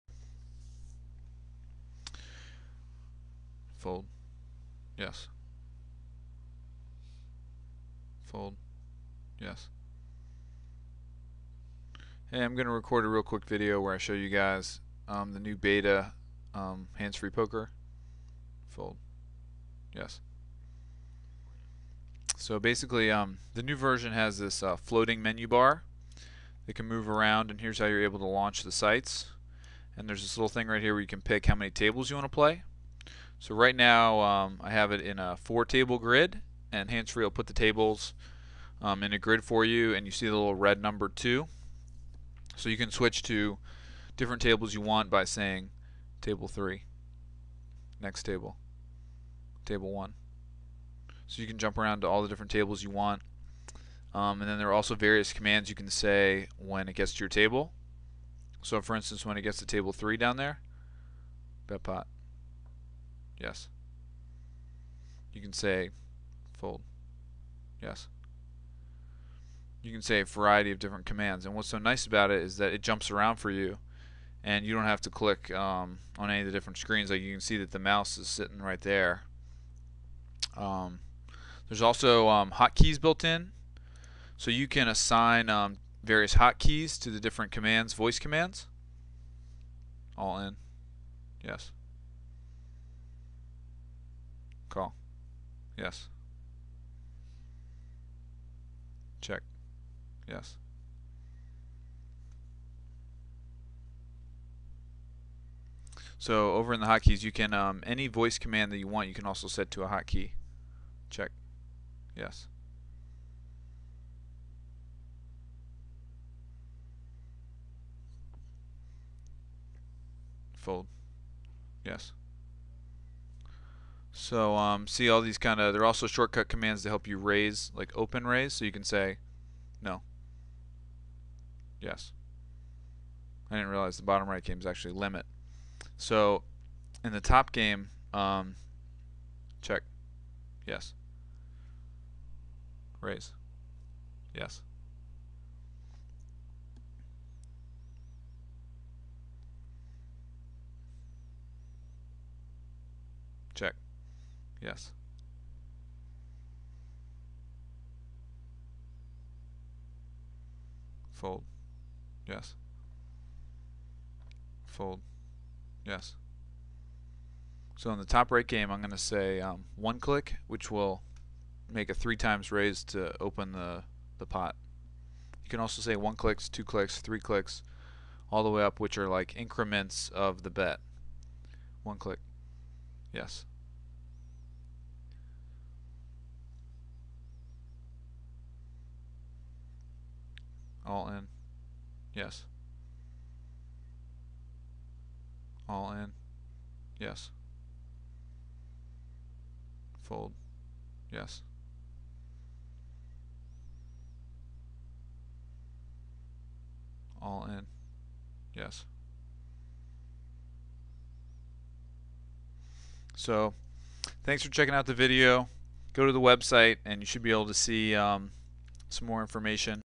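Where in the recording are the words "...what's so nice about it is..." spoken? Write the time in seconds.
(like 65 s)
71 s.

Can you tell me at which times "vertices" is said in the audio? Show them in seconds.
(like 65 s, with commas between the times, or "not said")
not said.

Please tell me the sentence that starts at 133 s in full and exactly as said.
I didn't realize the bottom right game is actually limit.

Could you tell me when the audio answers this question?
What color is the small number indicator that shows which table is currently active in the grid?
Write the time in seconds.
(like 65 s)
40 s.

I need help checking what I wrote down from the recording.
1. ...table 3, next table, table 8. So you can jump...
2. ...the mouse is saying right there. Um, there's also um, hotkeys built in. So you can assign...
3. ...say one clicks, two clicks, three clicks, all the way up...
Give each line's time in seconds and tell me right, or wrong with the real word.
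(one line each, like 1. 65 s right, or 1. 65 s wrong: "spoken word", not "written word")
1. 46 s wrong: "1", not "8"
2. 77 s wrong: "sitting", not "saying"
3. 175 s right.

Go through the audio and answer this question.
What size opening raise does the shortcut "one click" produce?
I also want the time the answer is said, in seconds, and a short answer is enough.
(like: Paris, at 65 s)
3 times, at 171 s.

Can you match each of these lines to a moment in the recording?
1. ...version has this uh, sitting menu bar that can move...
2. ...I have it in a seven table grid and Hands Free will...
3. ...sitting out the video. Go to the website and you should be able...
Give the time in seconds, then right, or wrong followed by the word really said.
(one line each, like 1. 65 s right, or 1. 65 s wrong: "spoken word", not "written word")
1. 23 s wrong: "floating", not "sitting"
2. 34 s wrong: "four", not "seven"
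3. 214 s wrong: "checking", not "sitting".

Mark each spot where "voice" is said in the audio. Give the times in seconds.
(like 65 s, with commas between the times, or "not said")
87 s, 108 s.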